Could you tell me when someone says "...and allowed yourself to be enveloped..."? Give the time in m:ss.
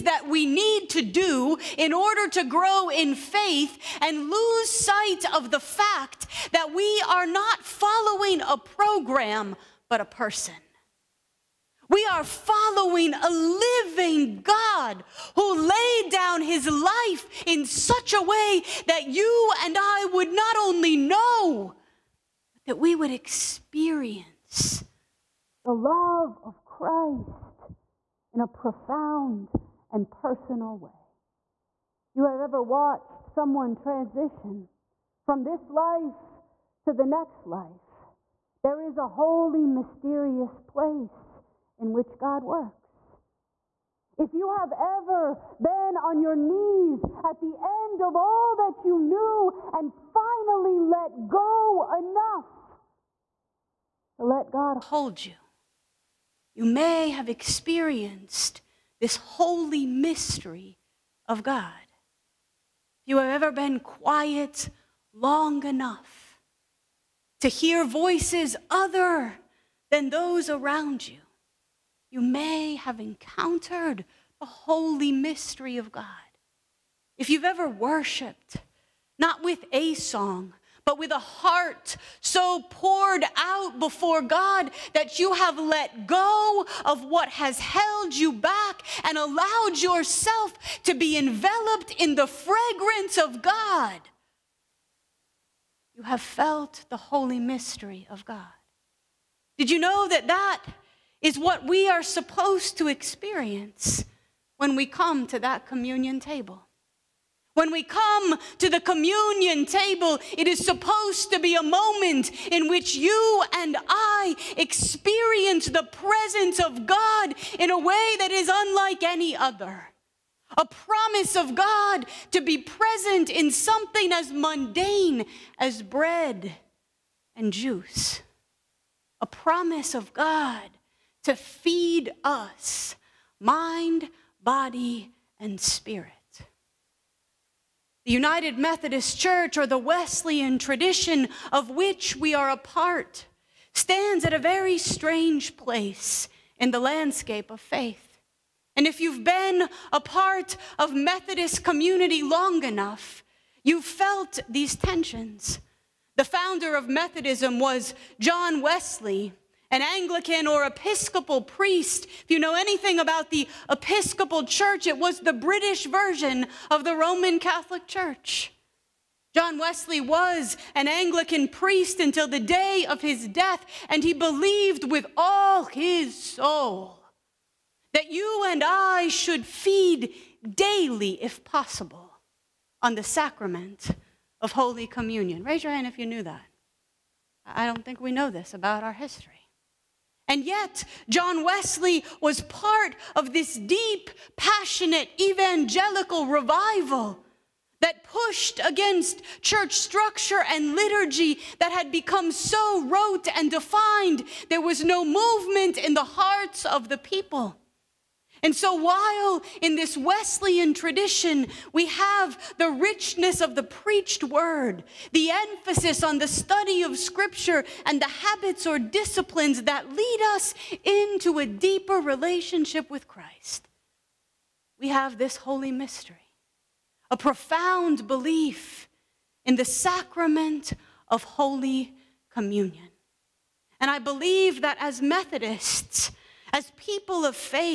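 1:29.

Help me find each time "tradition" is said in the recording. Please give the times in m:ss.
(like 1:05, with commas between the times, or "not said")
2:20, 3:30.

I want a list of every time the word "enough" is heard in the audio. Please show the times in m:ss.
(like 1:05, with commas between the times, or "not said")
0:51, 1:05, 2:32.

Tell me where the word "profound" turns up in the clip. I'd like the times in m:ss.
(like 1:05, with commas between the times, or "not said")
0:28, 3:47.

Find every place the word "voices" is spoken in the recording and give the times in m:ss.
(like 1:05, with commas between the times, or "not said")
1:07.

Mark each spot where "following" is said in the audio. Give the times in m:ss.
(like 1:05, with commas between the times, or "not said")
0:07, 0:12.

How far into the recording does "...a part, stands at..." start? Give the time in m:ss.
2:22.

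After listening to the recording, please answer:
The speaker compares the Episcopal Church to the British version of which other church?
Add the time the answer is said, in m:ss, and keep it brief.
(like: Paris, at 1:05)
Roman Catholic Church, at 2:46.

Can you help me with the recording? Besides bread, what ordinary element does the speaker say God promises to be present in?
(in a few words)
juice.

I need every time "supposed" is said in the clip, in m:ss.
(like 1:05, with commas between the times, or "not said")
1:42, 1:50.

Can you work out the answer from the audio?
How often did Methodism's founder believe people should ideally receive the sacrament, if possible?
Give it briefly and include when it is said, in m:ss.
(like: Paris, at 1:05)
daily, at 3:00.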